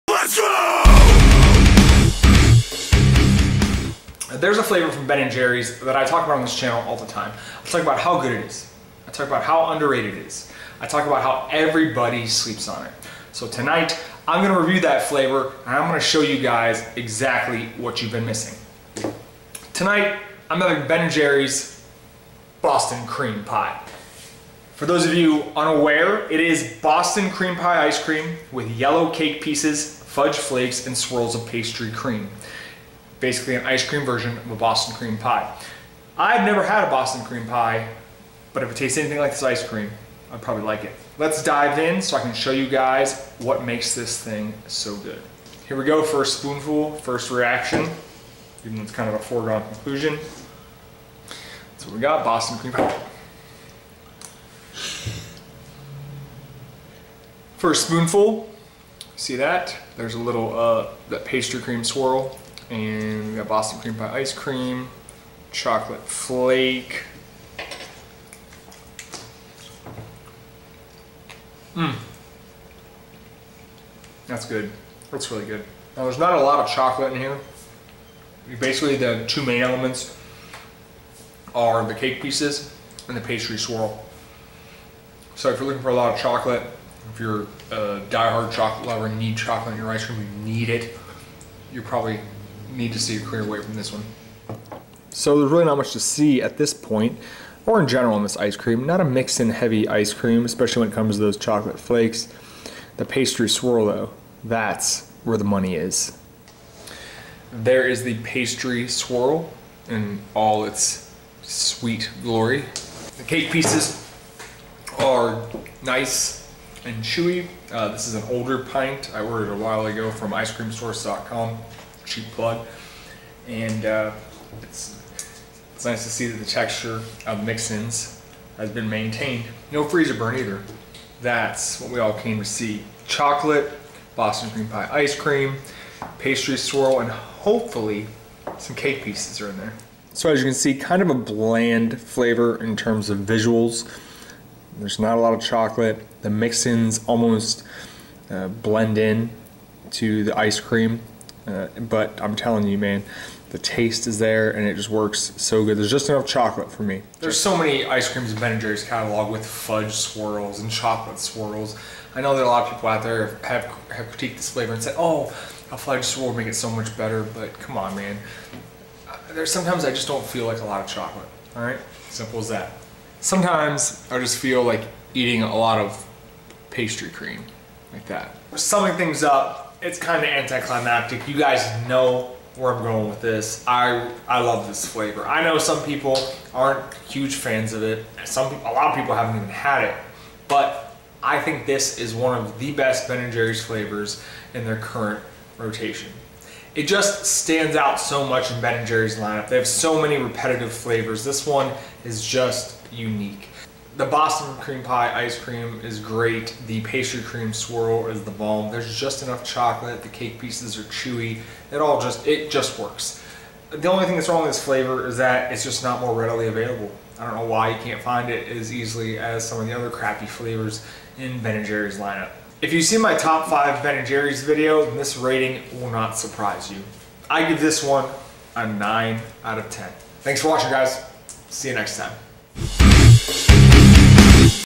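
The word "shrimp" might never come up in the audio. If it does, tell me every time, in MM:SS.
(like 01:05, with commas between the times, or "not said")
not said.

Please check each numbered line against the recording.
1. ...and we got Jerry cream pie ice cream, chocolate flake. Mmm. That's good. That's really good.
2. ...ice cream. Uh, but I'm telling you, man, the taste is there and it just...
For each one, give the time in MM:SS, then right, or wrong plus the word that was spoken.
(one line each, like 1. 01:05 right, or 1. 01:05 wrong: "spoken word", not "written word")
1. 01:02 wrong: "Boston", not "Jerry"
2. 02:30 right.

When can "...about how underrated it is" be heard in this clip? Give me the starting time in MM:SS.
00:09.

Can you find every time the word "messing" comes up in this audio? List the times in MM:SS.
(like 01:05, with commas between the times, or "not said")
not said.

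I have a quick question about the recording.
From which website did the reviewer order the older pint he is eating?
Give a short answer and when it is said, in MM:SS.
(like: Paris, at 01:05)
icecreamsource.com, at 02:00.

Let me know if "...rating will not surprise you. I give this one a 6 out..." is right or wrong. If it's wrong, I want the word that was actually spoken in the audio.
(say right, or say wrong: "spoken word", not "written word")
wrong: "9", not "6".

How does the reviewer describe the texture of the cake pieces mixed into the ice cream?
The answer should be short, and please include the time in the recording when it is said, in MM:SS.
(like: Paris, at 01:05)
Nice and chewy, at 01:55.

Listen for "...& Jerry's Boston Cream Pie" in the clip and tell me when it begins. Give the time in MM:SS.
00:21.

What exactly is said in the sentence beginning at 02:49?
Uh, there's sometimes I just don't feel like a lot of chocolate, all right?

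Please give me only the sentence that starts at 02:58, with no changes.
Summing things up, it's kind of anticlimactic.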